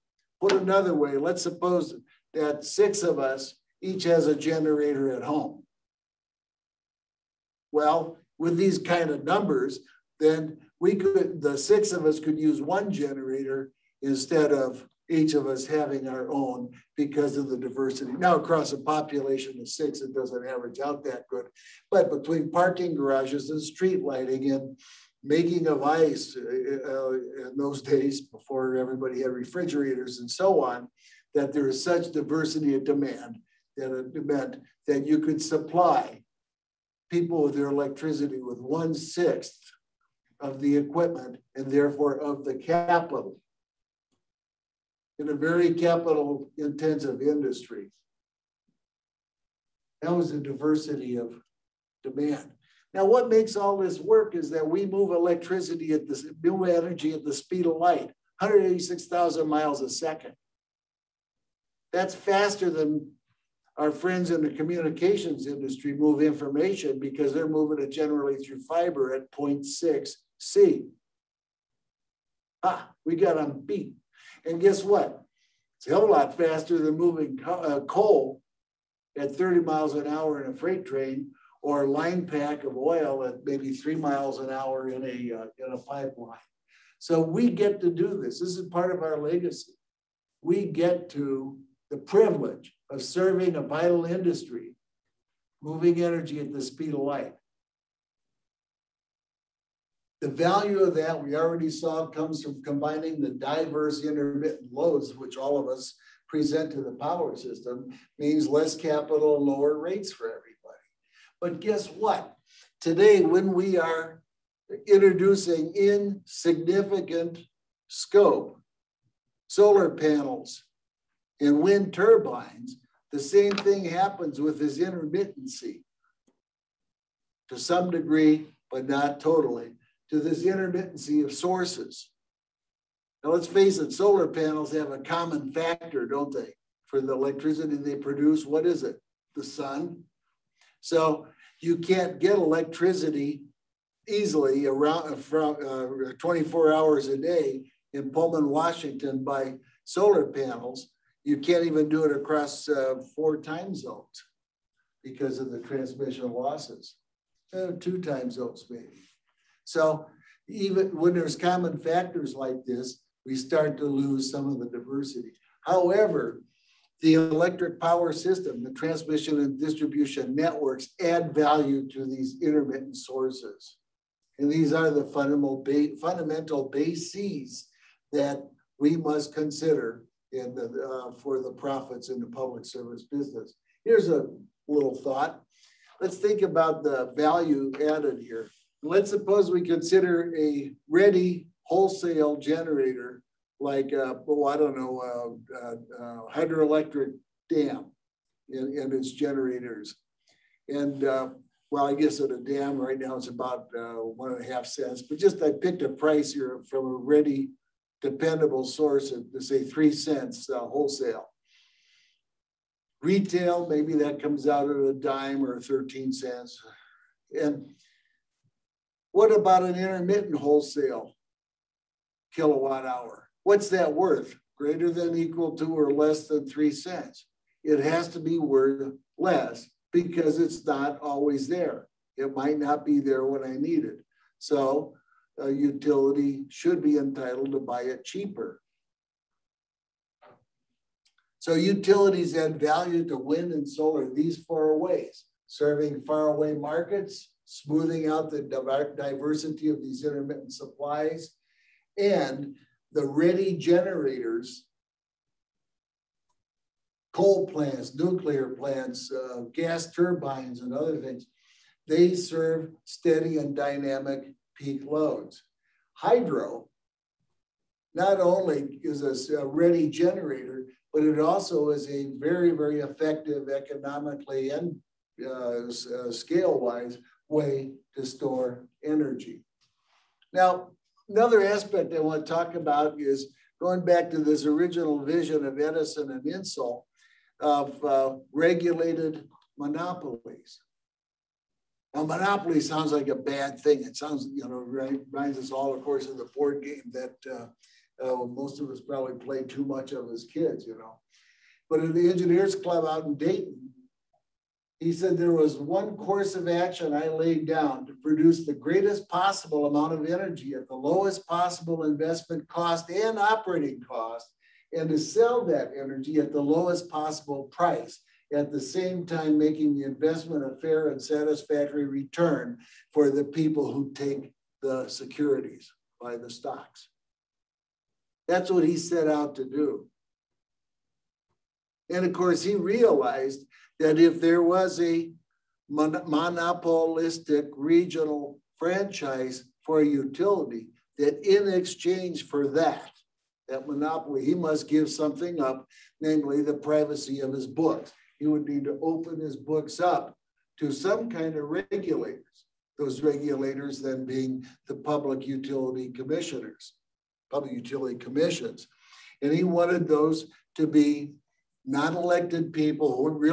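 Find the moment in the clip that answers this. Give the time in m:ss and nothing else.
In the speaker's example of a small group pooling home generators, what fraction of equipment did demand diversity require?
0:38.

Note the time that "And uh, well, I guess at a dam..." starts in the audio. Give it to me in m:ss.
3:20.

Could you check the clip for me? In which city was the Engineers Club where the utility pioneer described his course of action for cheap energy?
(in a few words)
Dayton.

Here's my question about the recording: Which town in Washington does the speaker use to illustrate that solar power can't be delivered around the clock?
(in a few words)
Pullman.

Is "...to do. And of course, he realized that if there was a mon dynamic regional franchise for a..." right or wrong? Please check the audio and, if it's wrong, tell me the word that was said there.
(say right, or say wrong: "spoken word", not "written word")
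wrong: "monopolistic", not "dynamic".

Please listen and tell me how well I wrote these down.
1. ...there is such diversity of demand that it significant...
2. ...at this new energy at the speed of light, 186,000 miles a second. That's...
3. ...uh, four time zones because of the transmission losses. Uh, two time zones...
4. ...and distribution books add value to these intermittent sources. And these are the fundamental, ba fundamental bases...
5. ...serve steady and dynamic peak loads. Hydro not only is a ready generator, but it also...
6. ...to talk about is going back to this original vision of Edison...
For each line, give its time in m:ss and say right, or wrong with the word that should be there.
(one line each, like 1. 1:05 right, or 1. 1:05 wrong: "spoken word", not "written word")
1. 0:31 wrong: "meant", not "significant"
2. 0:55 right
3. 2:32 right
4. 2:49 wrong: "networks", not "books"
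5. 4:22 right
6. 4:42 right.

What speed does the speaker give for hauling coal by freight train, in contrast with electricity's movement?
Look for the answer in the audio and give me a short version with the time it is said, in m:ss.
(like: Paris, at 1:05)
30 miles an hour, at 1:19.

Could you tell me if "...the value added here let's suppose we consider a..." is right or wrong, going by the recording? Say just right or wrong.
right.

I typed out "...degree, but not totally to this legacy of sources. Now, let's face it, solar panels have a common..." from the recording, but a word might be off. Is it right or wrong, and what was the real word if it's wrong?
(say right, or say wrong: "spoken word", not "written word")
wrong: "intermittency", not "legacy".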